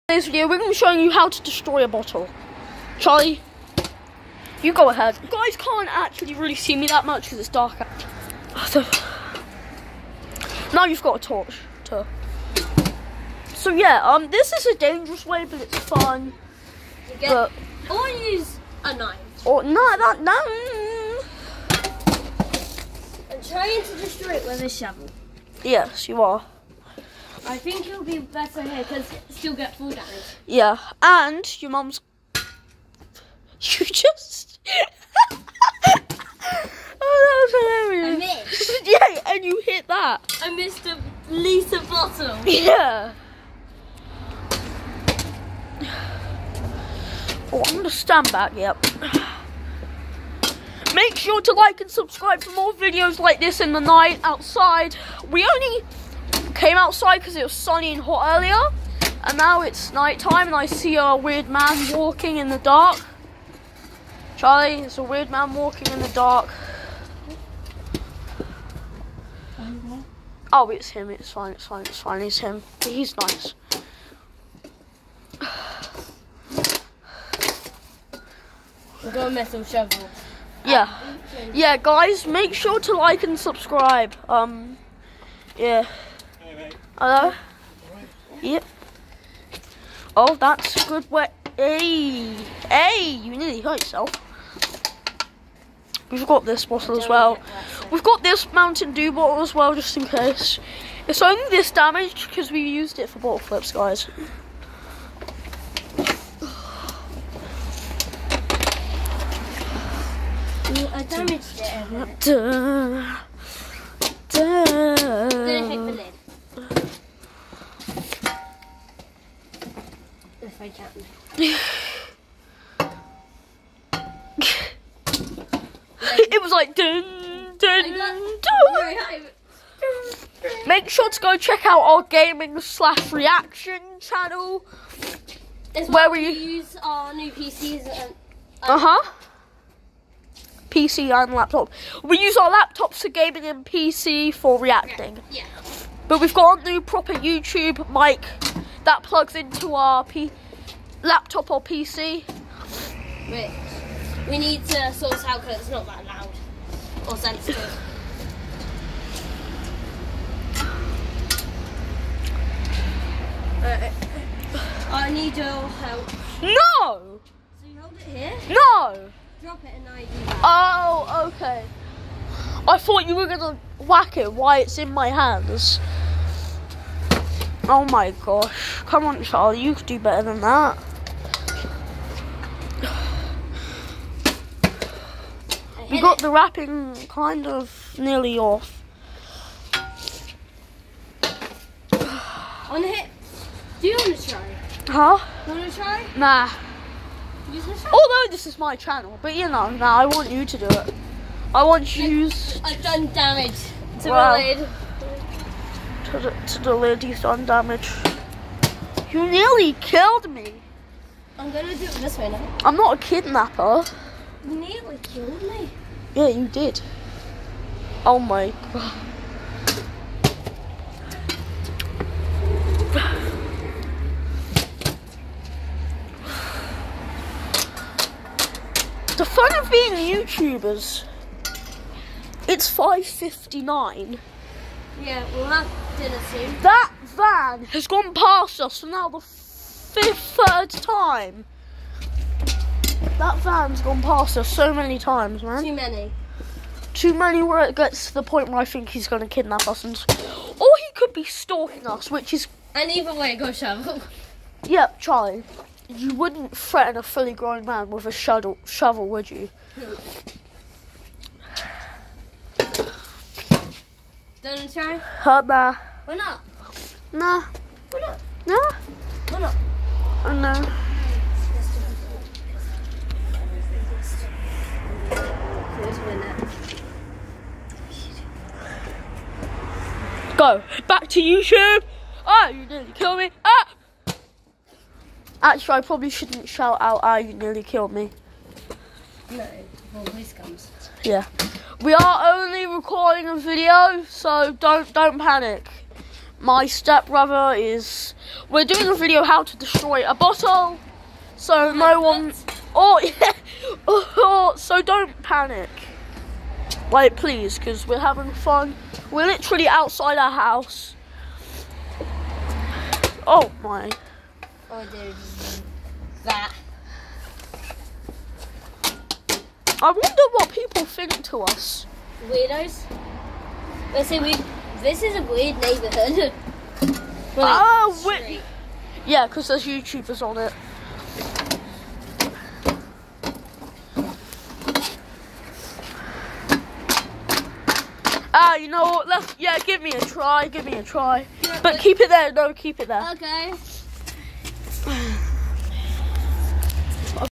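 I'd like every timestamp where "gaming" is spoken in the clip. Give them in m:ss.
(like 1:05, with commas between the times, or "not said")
2:12, 2:23.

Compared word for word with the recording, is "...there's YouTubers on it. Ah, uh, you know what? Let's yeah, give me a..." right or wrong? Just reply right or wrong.
right.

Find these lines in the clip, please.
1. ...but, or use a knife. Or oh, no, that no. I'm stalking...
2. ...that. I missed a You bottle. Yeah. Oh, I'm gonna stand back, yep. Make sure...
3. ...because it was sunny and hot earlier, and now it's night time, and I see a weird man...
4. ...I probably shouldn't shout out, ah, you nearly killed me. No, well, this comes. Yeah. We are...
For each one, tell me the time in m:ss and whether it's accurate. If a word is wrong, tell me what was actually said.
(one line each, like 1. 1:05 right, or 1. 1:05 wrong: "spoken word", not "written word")
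1. 0:17 wrong: "trying", not "stalking"
2. 0:39 wrong: "Lisa", not "You"
3. 0:57 right
4. 4:45 right.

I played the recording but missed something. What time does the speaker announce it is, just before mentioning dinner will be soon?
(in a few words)
5:59.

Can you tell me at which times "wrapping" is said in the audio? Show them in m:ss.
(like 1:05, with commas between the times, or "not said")
3:06.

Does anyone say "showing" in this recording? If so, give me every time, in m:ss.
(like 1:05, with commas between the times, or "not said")
0:00.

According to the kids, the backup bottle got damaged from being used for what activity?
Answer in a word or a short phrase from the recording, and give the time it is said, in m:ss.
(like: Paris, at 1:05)
Bottle flips, at 1:43.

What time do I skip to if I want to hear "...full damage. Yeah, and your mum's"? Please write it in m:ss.
0:29.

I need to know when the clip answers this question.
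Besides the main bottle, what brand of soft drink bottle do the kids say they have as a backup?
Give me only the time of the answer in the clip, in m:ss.
1:38.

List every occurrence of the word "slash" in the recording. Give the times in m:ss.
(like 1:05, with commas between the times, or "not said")
2:12.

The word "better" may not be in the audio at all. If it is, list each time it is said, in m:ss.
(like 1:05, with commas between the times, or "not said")
0:28, 2:59.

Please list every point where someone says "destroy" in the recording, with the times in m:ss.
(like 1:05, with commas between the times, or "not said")
0:01, 0:23, 4:59.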